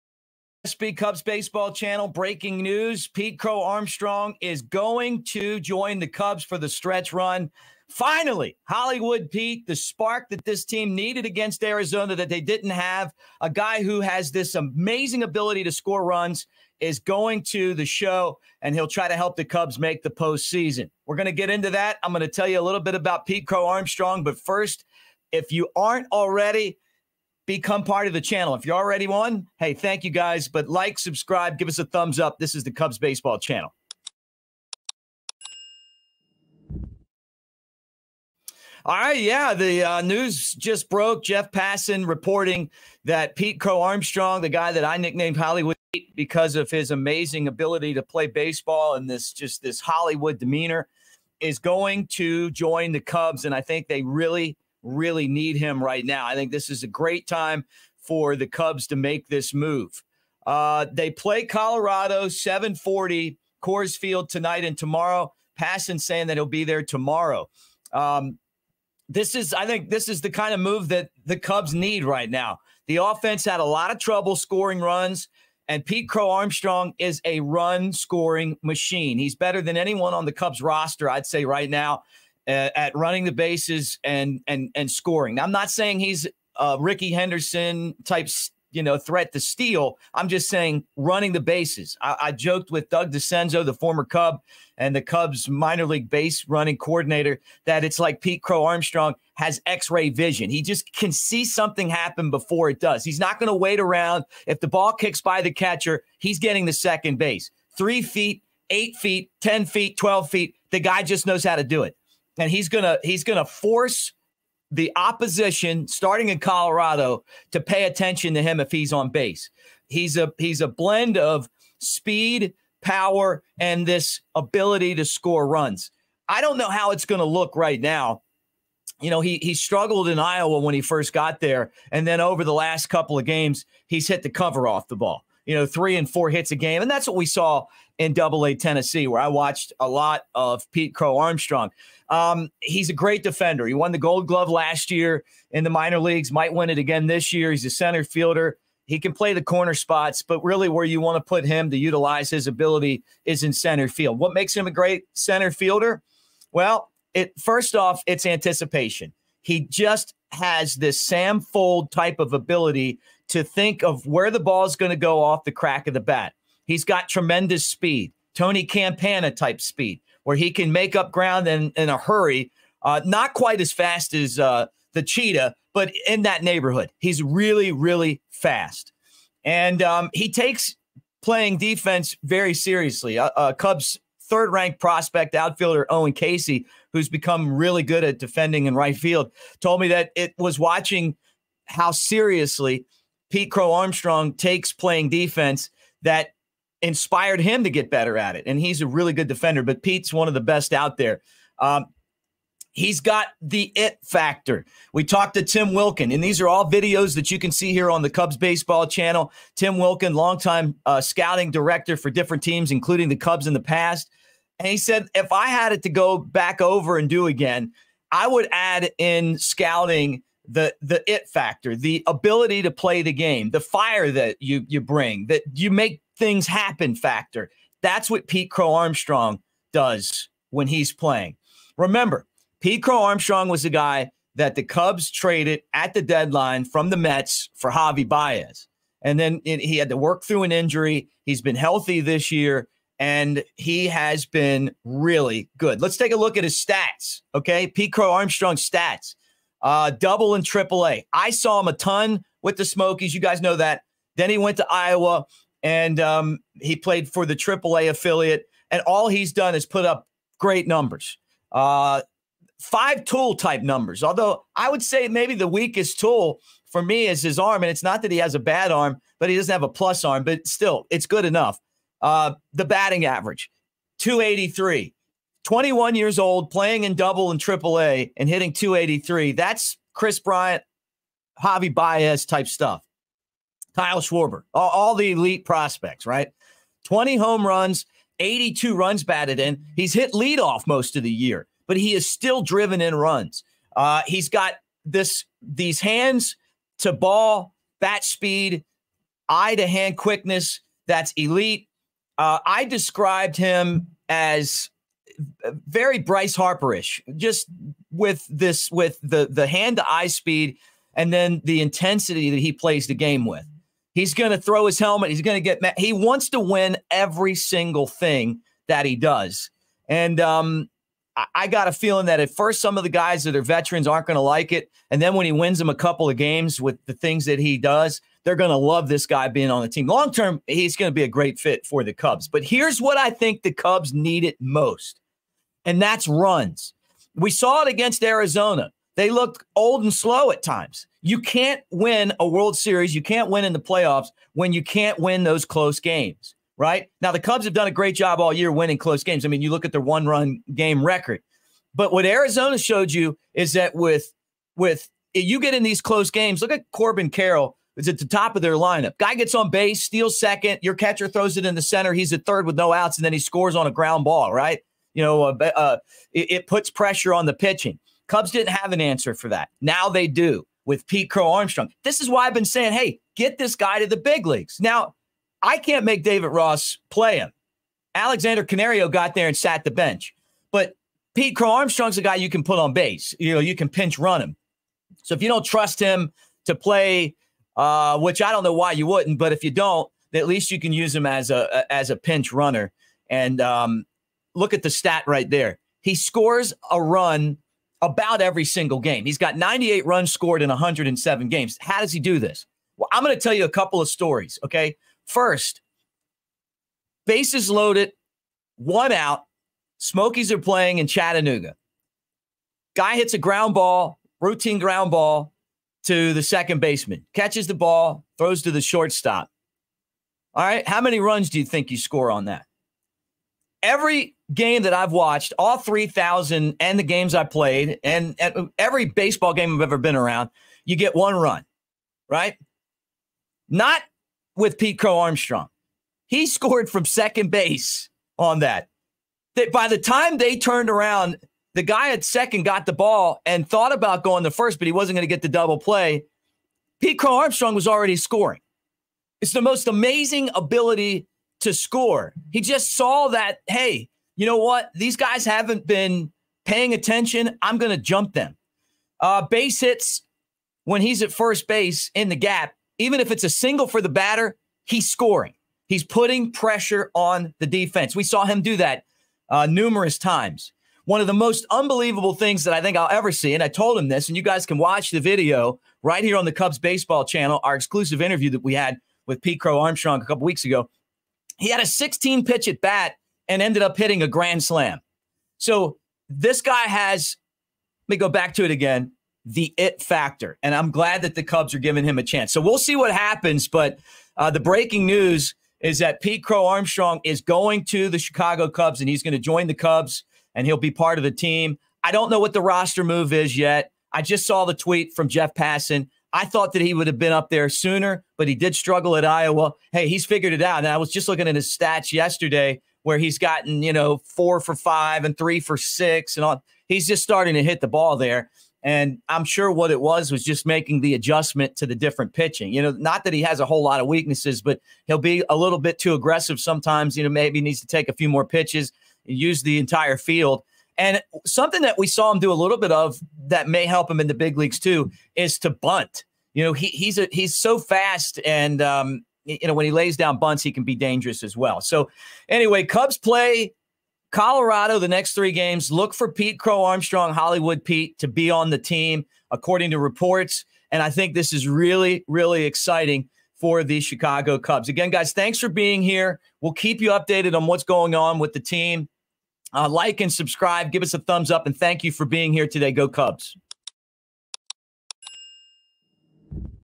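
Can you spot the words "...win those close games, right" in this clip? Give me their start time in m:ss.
5:44.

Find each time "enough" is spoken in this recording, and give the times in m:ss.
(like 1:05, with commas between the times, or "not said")
4:31.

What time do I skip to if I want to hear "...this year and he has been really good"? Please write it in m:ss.
4:02.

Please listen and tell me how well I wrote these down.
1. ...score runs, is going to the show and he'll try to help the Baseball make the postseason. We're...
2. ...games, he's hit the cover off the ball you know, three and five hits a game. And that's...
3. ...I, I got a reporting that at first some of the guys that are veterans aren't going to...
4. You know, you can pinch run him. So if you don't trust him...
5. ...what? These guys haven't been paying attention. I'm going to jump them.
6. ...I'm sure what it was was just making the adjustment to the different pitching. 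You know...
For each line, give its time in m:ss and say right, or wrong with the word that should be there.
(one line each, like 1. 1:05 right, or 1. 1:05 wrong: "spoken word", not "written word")
1. 0:15 wrong: "Cubs", not "Baseball"
2. 2:13 wrong: "four", not "five"
3. 5:21 wrong: "feeling", not "reporting"
4. 6:23 right
5. 7:34 right
6. 8:39 right.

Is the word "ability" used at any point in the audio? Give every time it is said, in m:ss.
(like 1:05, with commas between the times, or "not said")
0:15, 0:47, 2:04, 2:32, 2:42, 3:42, 7:30.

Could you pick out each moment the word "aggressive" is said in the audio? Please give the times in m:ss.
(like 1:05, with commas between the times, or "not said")
8:45.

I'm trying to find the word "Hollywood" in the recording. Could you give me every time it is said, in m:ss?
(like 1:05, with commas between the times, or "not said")
0:08, 0:45, 0:49, 9:07.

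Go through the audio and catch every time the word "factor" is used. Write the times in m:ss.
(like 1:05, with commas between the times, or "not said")
3:24, 3:41, 3:46, 8:09.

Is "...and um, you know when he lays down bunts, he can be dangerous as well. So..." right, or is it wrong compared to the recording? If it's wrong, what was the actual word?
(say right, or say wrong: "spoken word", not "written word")
right.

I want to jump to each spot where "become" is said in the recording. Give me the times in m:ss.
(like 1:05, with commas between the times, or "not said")
0:27, 3:07.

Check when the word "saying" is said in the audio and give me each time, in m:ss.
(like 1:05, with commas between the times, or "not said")
1:05, 1:25, 1:30, 6:12.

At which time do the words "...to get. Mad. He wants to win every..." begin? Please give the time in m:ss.
5:15.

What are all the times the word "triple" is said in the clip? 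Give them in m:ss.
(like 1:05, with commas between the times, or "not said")
4:10, 4:17, 4:37.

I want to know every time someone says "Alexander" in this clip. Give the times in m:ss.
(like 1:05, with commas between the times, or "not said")
6:17.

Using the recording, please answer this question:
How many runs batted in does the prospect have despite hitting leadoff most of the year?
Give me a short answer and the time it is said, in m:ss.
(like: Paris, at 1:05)
82, at 4:48.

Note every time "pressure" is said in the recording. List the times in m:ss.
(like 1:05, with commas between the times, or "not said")
6:06, 7:46.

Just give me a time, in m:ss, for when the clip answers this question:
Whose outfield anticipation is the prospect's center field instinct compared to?
2:40.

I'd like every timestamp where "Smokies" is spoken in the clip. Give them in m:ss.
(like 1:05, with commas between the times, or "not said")
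4:12, 6:49.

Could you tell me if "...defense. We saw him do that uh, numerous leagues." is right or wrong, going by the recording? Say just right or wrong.
wrong.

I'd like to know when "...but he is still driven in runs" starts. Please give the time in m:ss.
4:51.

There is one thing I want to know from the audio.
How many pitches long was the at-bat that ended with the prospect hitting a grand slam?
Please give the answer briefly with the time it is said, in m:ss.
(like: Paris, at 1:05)
16, at 8:01.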